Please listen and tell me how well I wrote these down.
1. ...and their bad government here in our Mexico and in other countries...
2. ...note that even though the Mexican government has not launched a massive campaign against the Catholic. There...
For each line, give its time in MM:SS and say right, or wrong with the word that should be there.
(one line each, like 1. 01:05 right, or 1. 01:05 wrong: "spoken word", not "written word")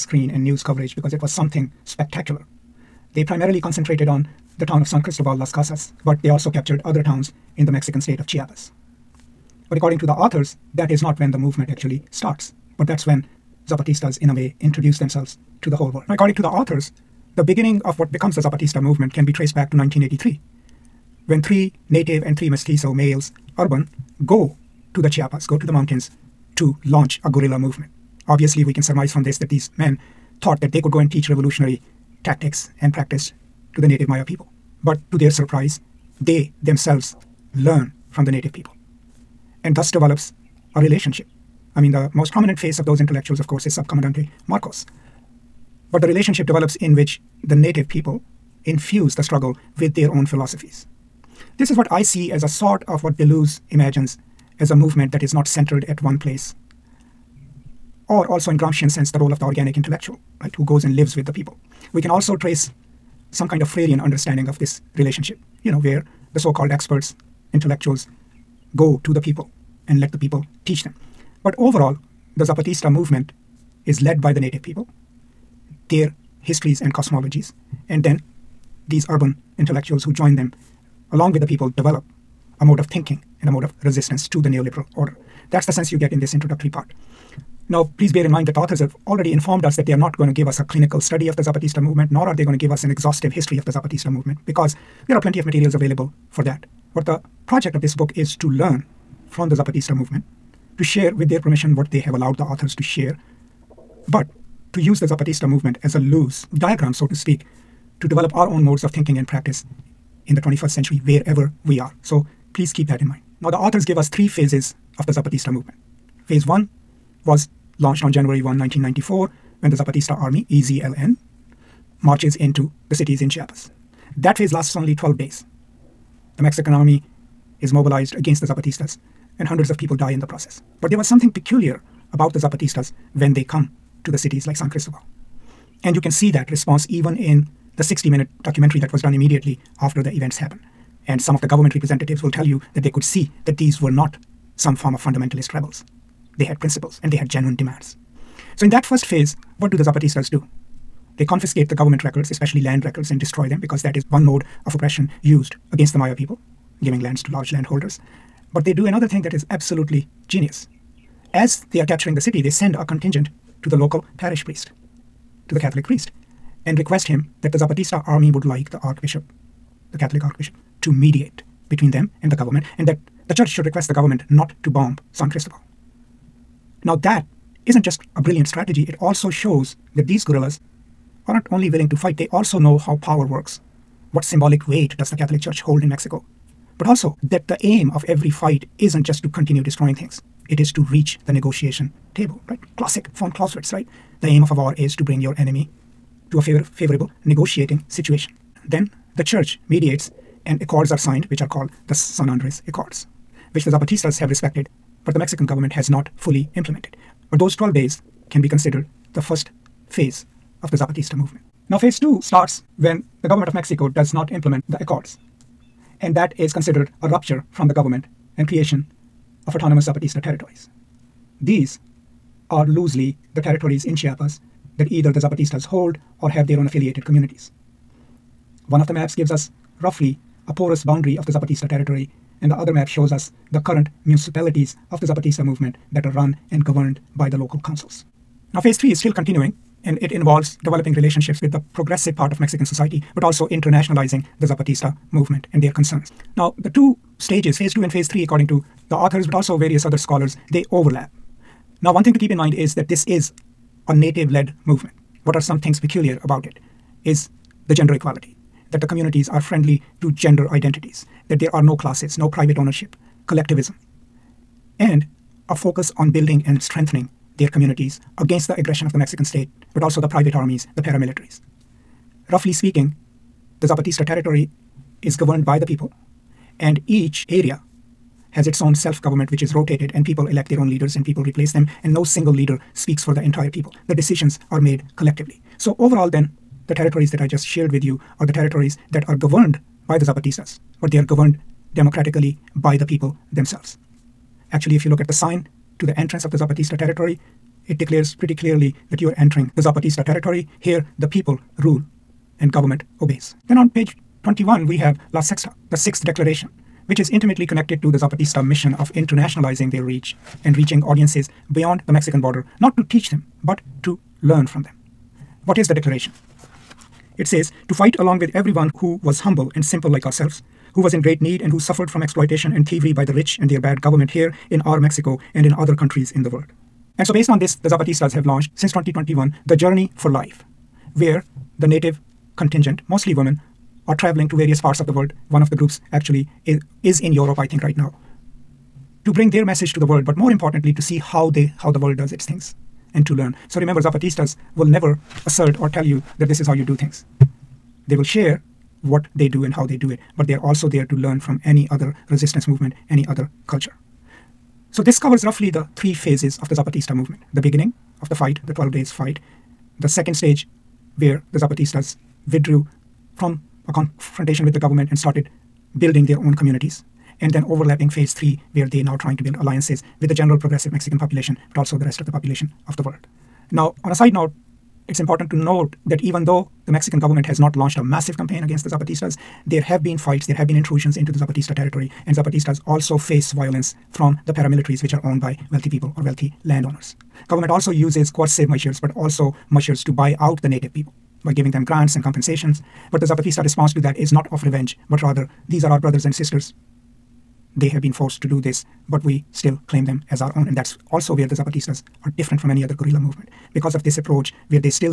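1. 05:23 right
2. 06:15 wrong: "Zapatistas", not "Catholic".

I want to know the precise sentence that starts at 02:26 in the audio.
They had principles and they had genuine demands.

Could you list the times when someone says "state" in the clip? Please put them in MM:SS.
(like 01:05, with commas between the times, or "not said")
00:08, 04:29.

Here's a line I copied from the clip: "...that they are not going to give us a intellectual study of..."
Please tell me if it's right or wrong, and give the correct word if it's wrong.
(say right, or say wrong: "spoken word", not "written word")
wrong: "clinical", not "intellectual".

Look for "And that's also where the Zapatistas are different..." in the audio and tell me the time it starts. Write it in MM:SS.
06:40.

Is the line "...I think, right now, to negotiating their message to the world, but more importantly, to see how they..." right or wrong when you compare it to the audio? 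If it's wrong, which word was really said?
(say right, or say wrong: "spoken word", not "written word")
wrong: "bring", not "negotiating".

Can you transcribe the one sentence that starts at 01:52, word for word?
So please keep that in mind.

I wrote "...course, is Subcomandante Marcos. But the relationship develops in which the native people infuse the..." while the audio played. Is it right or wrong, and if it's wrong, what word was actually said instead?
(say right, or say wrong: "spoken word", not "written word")
right.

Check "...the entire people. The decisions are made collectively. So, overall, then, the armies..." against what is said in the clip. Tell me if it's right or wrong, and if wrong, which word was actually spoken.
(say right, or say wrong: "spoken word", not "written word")
wrong: "territories", not "armies".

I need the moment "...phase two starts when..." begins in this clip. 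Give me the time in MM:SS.
03:31.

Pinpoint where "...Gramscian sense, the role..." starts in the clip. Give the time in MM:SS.
00:58.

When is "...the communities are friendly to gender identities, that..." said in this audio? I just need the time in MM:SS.
04:18.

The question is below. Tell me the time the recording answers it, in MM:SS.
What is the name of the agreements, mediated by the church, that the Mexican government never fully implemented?
03:21.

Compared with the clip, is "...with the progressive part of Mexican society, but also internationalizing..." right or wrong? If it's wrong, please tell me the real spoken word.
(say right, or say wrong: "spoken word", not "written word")
right.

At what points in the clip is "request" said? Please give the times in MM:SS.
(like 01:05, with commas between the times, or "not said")
02:46, 02:53.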